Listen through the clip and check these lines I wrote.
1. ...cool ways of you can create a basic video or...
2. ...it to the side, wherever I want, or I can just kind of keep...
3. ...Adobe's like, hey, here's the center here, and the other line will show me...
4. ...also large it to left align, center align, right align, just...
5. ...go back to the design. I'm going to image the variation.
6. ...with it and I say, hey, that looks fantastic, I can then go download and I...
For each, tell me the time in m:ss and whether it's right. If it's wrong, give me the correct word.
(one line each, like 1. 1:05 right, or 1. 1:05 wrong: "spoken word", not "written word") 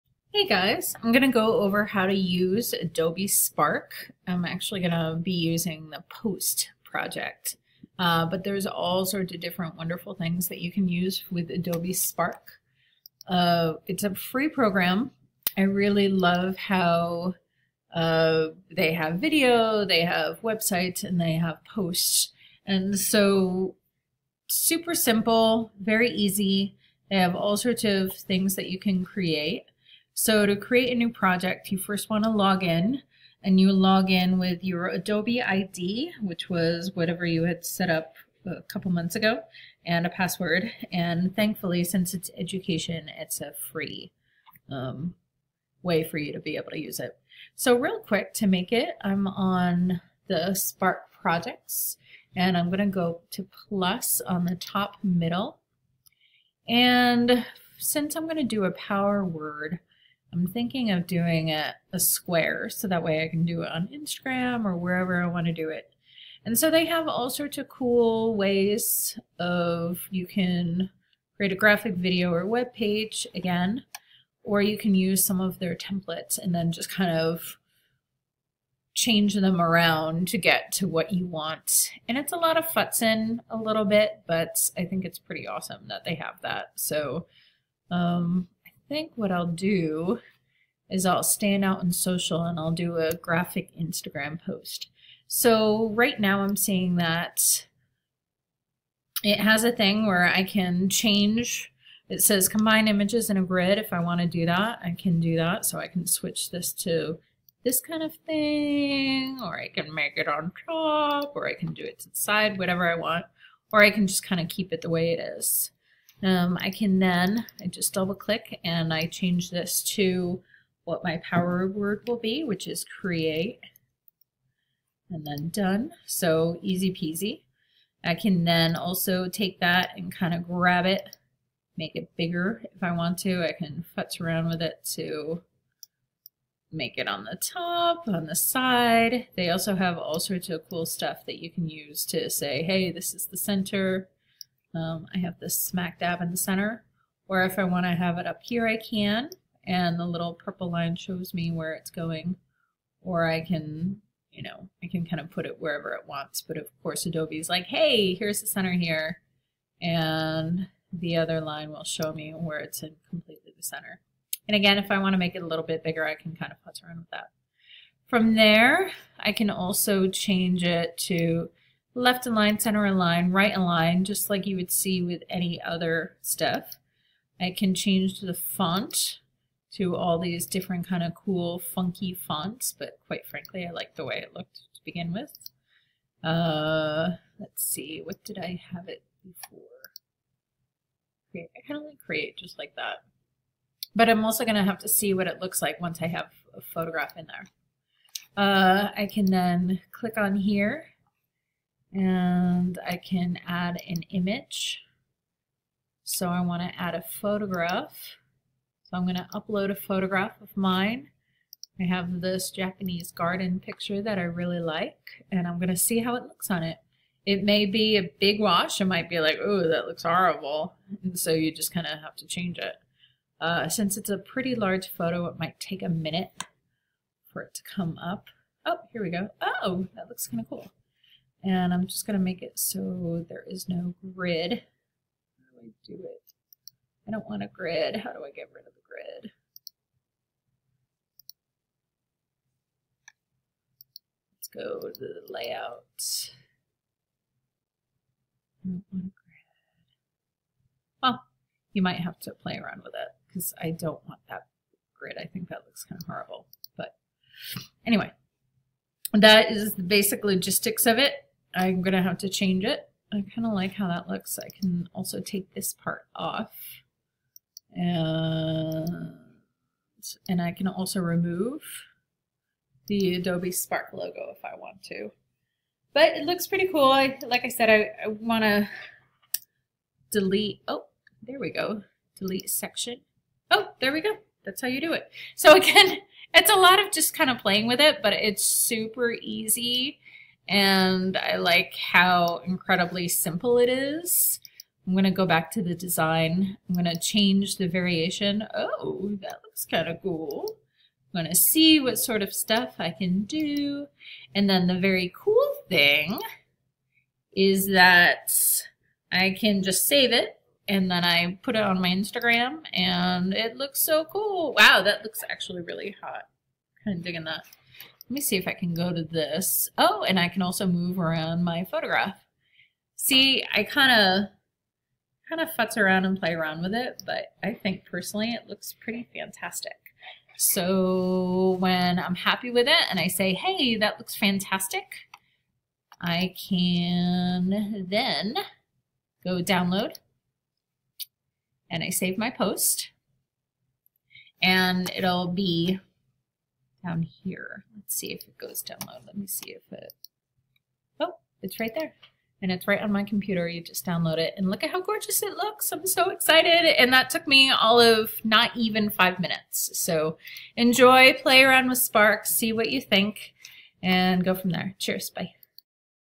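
1. 1:07 wrong: "graphic", not "basic"
2. 1:51 wrong: "whatever", not "wherever"
3. 2:37 right
4. 2:49 wrong: "change", not "large"
5. 4:55 wrong: "change", not "image"
6. 5:32 right.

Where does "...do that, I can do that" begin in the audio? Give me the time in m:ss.
1:44.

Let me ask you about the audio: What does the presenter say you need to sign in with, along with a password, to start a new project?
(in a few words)
Adobe ID.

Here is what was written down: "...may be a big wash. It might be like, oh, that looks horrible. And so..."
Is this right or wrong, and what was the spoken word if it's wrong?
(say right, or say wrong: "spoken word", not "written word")
right.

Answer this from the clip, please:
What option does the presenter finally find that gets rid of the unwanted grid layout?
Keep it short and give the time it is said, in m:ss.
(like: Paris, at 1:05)
Delete section, at 4:42.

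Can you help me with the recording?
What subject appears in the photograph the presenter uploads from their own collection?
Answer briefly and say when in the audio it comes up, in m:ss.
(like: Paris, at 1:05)
Japanese garden, at 3:32.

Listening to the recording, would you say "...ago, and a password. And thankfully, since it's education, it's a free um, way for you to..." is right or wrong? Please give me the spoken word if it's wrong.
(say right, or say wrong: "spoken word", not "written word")
right.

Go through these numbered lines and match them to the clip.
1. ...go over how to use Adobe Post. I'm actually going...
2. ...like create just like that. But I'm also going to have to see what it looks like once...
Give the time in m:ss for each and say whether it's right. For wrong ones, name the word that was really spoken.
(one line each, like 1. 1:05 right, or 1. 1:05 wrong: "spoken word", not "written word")
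1. 0:01 wrong: "Spark", not "Post"
2. 3:11 right.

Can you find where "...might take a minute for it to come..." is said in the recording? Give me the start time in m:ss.
3:45.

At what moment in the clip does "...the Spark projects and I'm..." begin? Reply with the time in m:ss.
0:50.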